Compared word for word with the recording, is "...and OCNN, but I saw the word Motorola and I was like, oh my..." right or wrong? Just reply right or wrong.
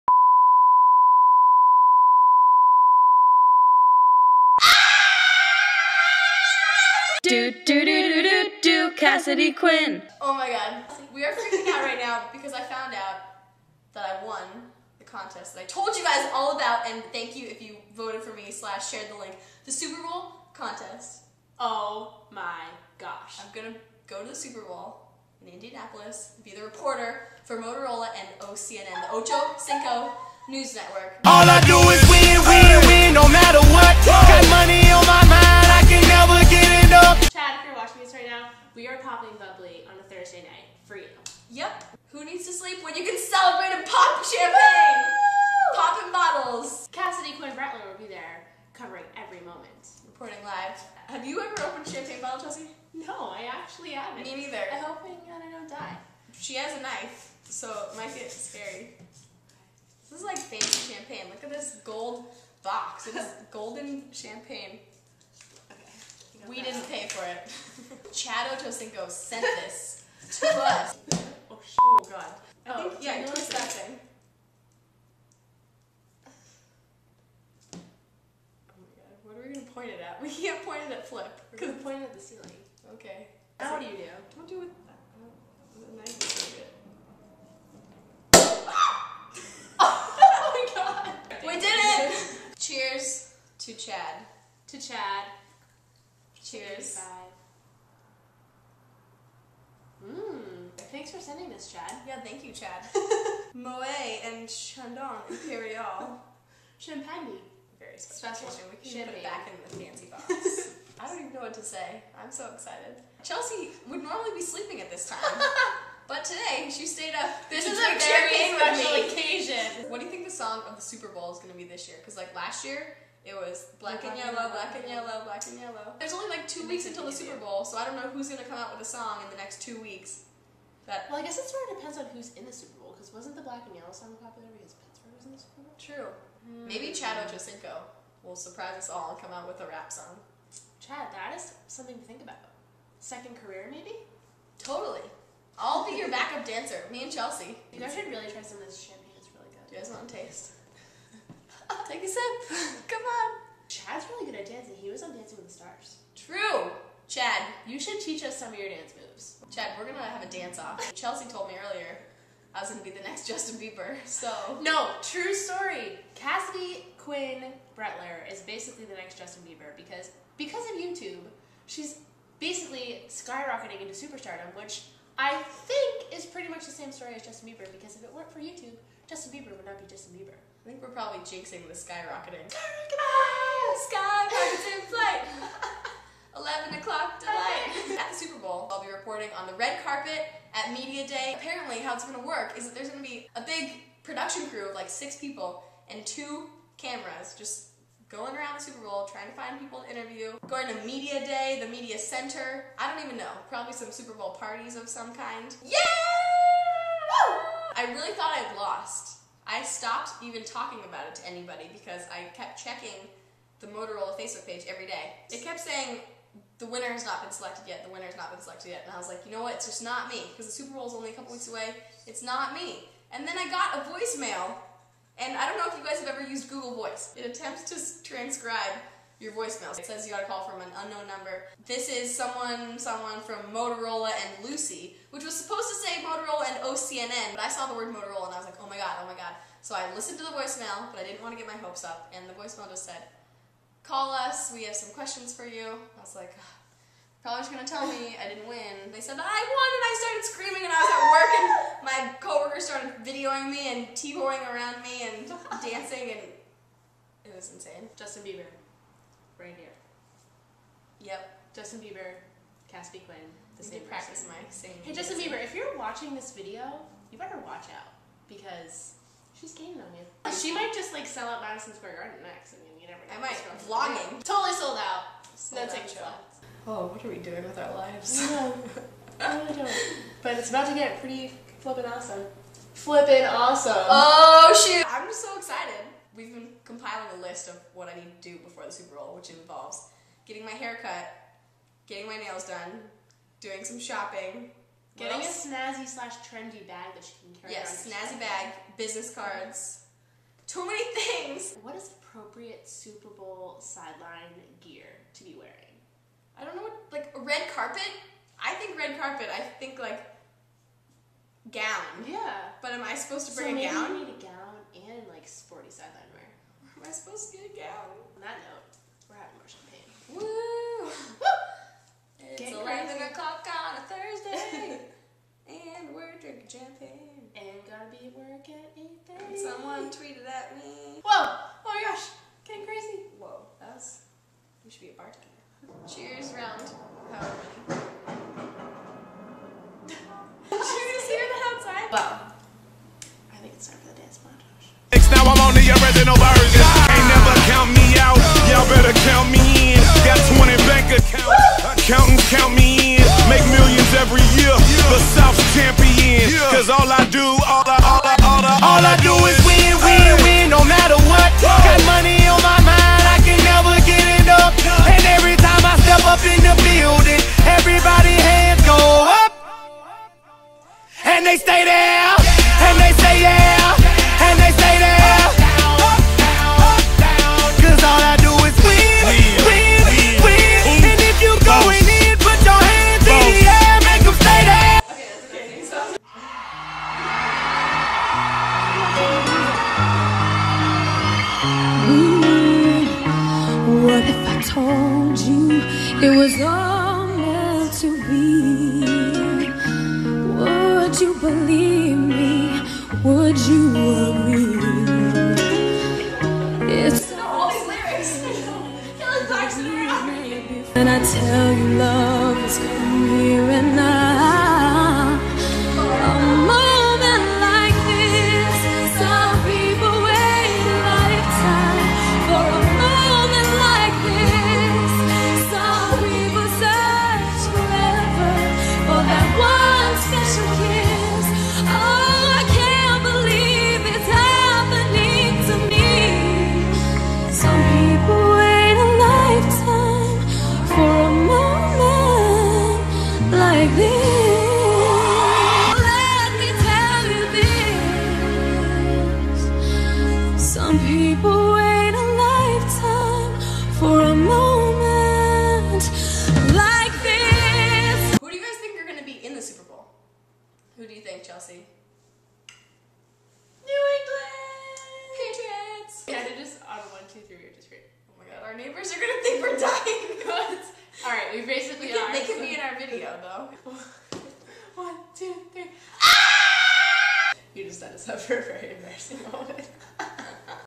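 right.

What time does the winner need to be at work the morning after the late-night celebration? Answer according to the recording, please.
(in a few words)
8:30.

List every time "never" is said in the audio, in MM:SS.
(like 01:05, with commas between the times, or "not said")
04:32.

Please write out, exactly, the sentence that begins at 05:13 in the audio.
You need a gown and like sporty sideline wear.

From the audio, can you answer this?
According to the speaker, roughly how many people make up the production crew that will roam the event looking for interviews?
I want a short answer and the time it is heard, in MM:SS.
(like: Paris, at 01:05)
6, at 03:14.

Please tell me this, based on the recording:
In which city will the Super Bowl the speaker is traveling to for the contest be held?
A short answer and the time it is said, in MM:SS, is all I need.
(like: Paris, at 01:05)
Indianapolis, at 00:25.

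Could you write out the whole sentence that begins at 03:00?
I think we're probably jinxing the skyrocketing.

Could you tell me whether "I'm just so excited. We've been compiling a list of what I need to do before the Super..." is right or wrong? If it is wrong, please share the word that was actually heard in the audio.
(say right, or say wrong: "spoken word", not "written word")
right.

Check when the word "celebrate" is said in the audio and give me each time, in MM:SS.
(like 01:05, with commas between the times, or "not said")
00:43.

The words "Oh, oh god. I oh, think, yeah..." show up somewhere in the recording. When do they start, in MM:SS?
01:11.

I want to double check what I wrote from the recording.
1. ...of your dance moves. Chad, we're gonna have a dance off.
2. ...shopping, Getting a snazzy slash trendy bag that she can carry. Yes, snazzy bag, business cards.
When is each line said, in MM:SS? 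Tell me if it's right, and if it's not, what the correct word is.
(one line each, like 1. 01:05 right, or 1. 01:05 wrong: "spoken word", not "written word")
1. 02:38 right
2. 04:53 right.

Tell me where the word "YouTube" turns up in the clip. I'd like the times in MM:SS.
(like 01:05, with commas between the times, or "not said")
02:50, 02:58.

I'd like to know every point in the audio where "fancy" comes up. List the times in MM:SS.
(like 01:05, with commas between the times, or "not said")
01:00, 01:49.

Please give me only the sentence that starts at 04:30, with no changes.
She might just like sell out Madison Square Garden next.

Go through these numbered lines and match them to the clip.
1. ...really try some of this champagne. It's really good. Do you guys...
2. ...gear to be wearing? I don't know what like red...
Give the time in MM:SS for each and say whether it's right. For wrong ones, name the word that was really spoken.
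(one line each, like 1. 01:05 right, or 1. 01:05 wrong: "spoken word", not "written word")
1. 02:28 right
2. 05:04 right.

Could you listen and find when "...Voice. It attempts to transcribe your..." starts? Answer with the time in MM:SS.
03:46.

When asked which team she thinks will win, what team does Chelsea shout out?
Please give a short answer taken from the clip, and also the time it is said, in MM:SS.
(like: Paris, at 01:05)
New England Patriots, at 07:43.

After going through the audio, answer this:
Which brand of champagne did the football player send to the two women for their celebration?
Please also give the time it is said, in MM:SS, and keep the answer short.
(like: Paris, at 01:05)
Moët and Chandon Imperial, at 01:43.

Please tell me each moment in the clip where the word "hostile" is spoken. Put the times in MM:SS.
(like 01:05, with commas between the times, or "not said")
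not said.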